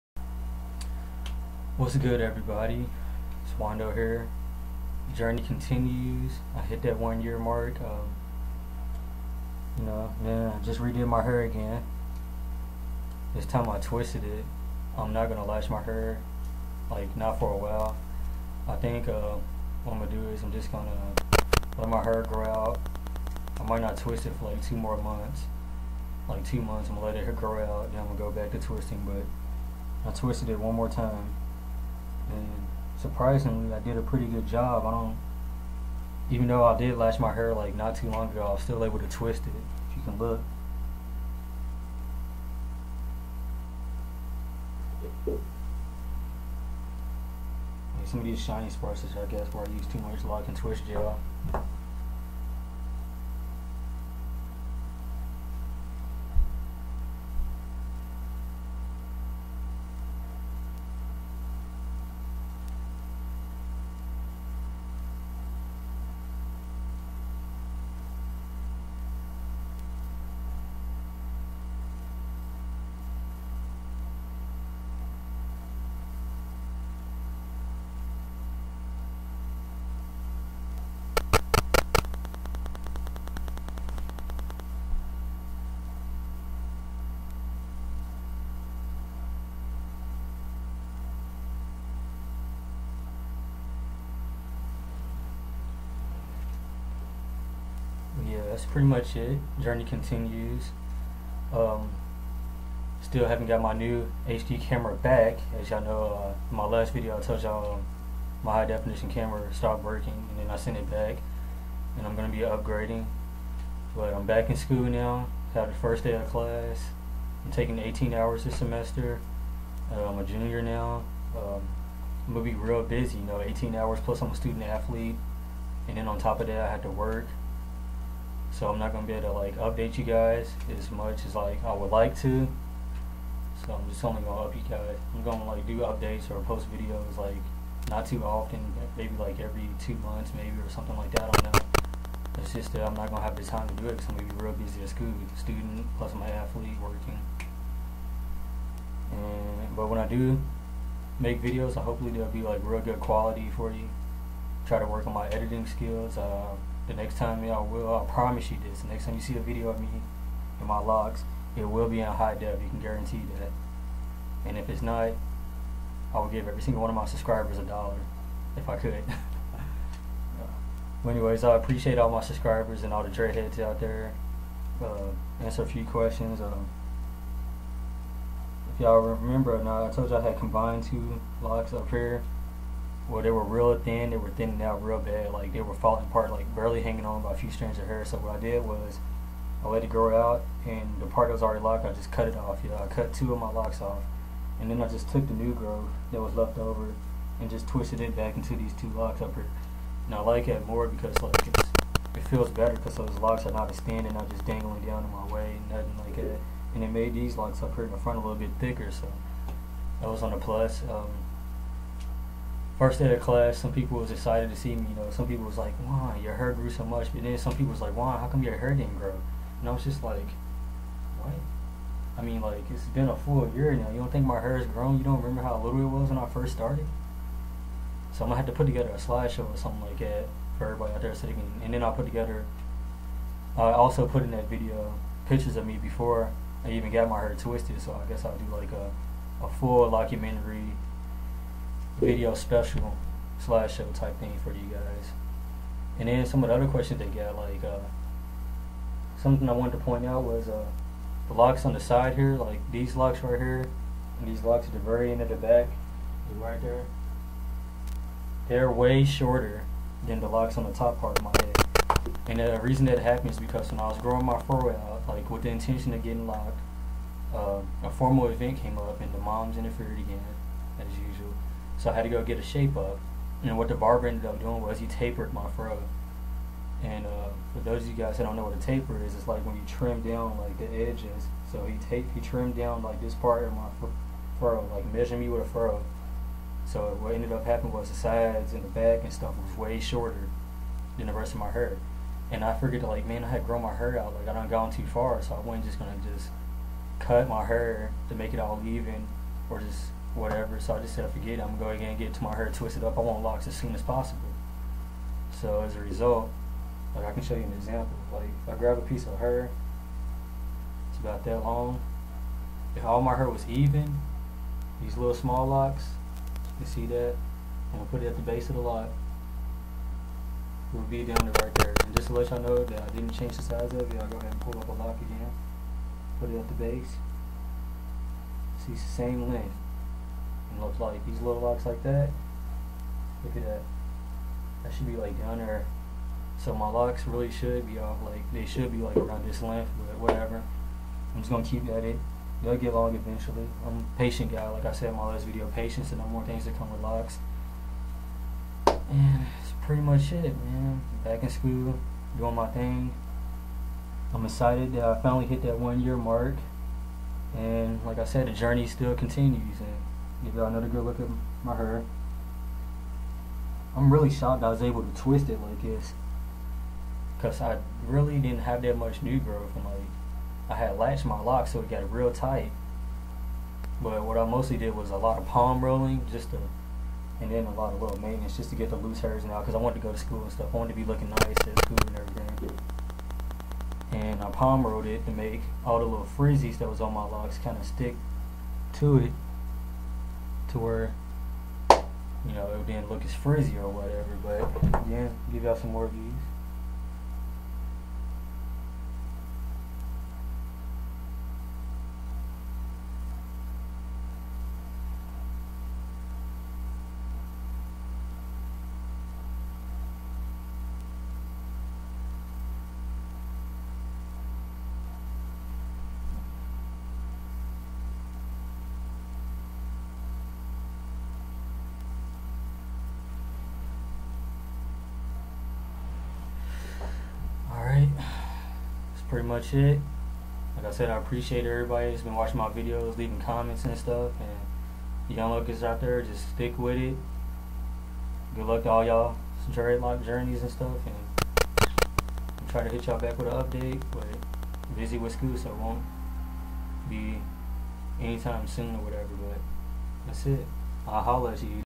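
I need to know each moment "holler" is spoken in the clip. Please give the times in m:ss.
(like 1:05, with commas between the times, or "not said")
7:31.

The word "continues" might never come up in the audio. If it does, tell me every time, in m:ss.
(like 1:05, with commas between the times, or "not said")
0:05, 1:39, 5:58.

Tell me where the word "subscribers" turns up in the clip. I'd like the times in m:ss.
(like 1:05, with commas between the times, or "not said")
2:47, 2:52.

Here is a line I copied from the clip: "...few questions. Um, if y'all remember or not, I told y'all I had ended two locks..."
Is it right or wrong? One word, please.
wrong.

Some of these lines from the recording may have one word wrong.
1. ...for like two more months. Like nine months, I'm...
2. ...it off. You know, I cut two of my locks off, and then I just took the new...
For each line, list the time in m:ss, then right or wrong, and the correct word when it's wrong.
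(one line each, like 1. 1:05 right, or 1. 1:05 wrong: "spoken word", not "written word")
1. 0:24 wrong: "two", not "nine"
2. 3:12 right.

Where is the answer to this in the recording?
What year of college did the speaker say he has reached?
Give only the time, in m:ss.
2:00.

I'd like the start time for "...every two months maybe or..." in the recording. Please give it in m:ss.
2:19.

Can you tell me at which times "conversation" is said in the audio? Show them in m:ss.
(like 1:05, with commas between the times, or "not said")
not said.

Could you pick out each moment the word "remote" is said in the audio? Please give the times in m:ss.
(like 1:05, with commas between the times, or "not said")
not said.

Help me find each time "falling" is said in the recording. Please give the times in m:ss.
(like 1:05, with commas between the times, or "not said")
3:05.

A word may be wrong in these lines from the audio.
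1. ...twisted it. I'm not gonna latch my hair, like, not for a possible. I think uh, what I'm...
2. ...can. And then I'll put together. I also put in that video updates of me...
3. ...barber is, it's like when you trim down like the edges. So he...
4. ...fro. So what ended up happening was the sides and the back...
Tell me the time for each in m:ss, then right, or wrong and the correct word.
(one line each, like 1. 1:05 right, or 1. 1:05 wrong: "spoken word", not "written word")
1. 0:13 wrong: "while", not "possible"
2. 3:51 wrong: "pictures", not "updates"
3. 4:38 wrong: "taper", not "barber"
4. 4:45 right.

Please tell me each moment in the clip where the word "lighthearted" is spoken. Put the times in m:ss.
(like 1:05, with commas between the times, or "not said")
not said.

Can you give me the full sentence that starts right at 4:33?
And what the barber ended up doing was he tapered my fro.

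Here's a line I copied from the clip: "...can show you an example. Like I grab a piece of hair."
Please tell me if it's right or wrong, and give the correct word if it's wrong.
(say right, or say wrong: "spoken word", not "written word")
right.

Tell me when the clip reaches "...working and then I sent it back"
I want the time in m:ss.
1:49.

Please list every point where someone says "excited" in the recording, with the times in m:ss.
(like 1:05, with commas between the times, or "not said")
3:34, 5:54.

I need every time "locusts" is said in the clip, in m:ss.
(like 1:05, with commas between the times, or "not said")
7:15.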